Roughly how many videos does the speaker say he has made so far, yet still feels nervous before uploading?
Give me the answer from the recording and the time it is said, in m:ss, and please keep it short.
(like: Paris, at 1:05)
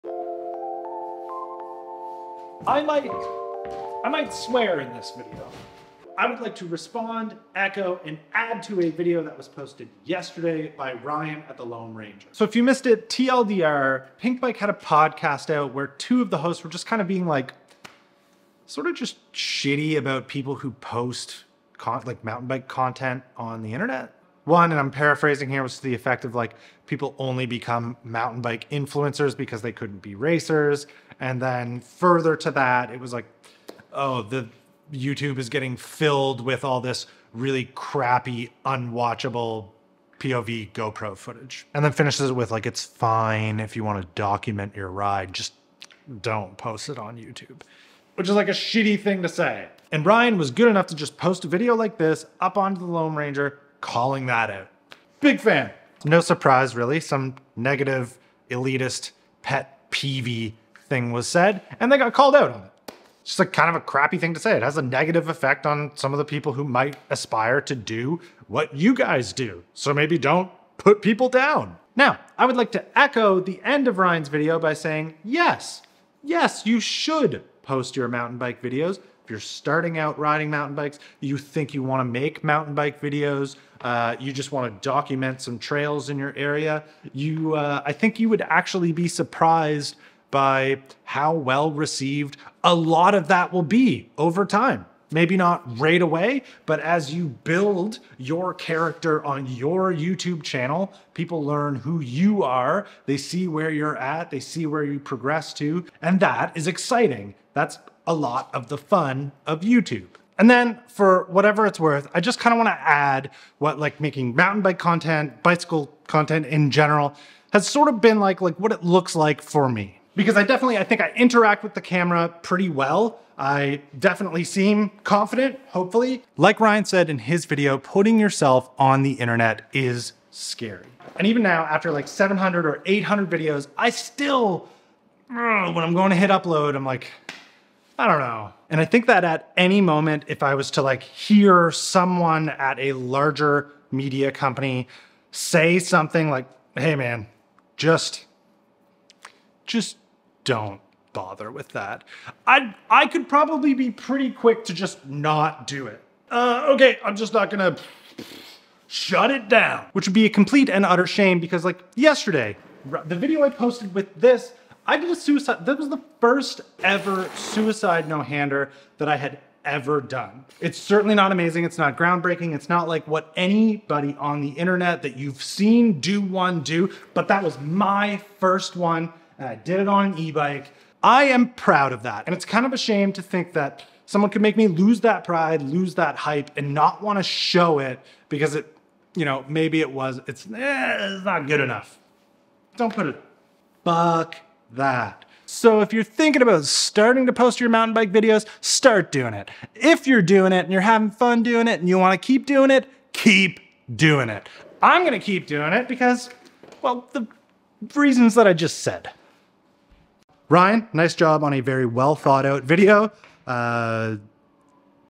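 700 or 800, at 2:12.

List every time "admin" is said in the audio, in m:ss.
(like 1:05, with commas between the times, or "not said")
not said.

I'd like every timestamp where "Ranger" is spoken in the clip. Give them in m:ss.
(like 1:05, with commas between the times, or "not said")
0:11, 0:53.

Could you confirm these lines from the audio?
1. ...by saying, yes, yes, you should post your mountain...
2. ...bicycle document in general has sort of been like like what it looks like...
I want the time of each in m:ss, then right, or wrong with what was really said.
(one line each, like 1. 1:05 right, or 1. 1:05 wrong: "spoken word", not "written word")
1. 1:14 right
2. 1:55 wrong: "content", not "document".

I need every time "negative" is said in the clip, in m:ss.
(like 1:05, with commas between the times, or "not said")
0:57, 1:04.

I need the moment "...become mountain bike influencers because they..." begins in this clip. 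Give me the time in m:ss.
0:27.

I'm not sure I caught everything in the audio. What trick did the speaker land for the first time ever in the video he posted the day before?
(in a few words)
suicide no-hander.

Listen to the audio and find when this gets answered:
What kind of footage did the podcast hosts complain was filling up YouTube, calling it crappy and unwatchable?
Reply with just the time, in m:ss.
0:40.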